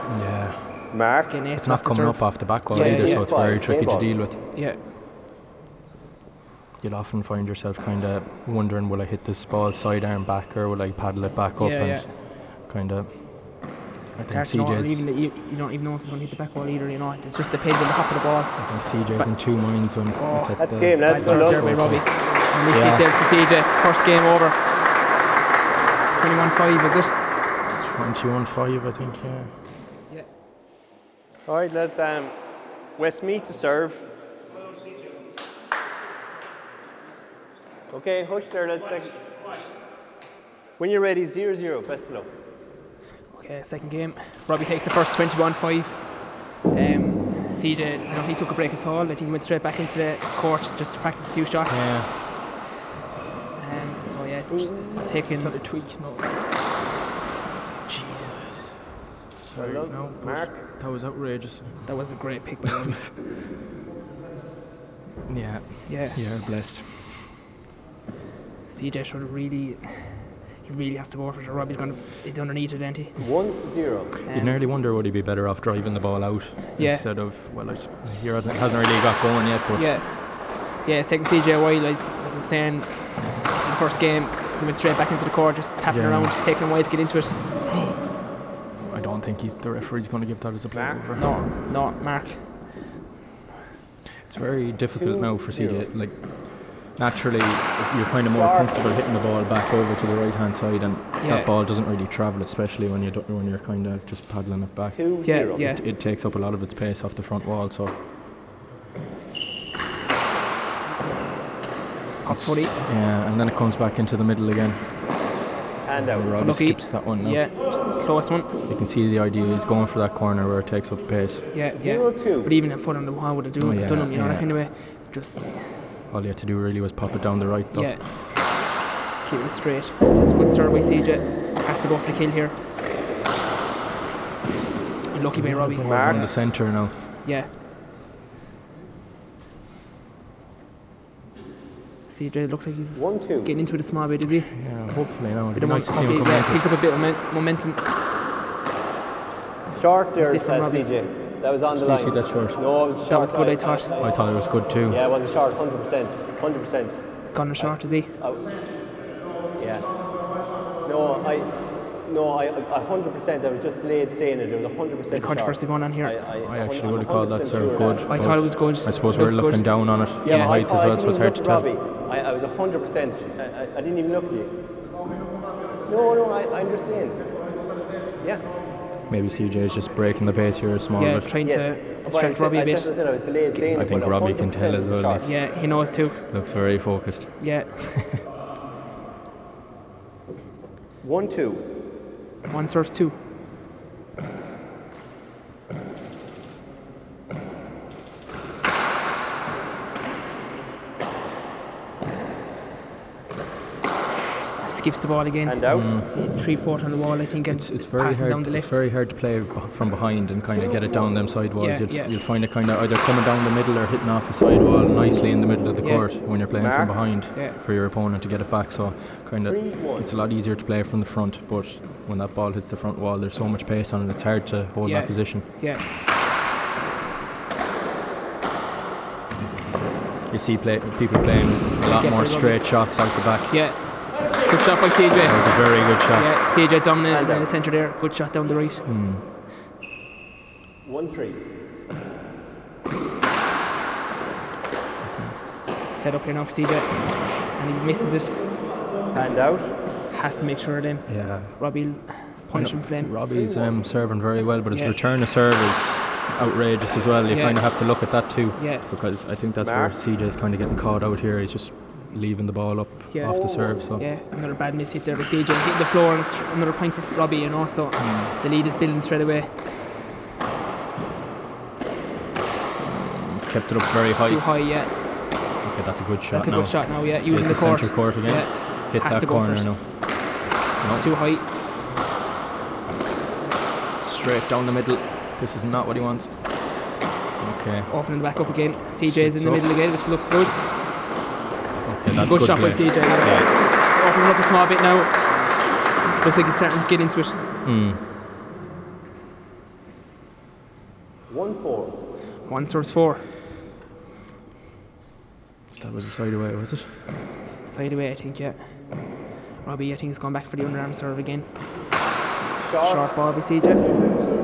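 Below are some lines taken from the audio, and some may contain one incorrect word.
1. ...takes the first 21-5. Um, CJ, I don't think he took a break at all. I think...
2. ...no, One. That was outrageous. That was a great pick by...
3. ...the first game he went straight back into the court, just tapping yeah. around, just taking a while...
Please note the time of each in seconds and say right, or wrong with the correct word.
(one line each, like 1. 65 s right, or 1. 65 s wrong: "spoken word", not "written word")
1. 44 s right
2. 59 s wrong: "Mark", not "One"
3. 82 s right.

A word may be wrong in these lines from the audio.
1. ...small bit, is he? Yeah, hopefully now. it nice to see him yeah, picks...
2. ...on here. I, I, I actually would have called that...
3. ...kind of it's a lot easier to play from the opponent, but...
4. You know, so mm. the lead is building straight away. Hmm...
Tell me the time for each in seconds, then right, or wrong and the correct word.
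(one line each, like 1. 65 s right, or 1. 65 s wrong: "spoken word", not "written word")
1. 143 s right
2. 165 s right
3. 219 s wrong: "front", not "opponent"
4. 267 s right.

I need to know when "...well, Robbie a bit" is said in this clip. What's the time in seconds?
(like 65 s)
182 s.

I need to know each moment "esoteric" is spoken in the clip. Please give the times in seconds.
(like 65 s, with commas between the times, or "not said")
not said.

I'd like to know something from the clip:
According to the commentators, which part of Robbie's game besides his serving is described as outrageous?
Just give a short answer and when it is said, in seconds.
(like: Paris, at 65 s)
Return to serve, at 254 s.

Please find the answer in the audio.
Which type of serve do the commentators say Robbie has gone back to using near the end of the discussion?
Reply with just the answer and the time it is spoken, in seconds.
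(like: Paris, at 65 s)
Underarm serve, at 310 s.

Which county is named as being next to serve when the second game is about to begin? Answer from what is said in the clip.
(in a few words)
Westmeath.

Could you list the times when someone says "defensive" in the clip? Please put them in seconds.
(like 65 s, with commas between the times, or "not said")
not said.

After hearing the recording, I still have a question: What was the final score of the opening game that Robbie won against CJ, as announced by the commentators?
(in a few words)
21-5.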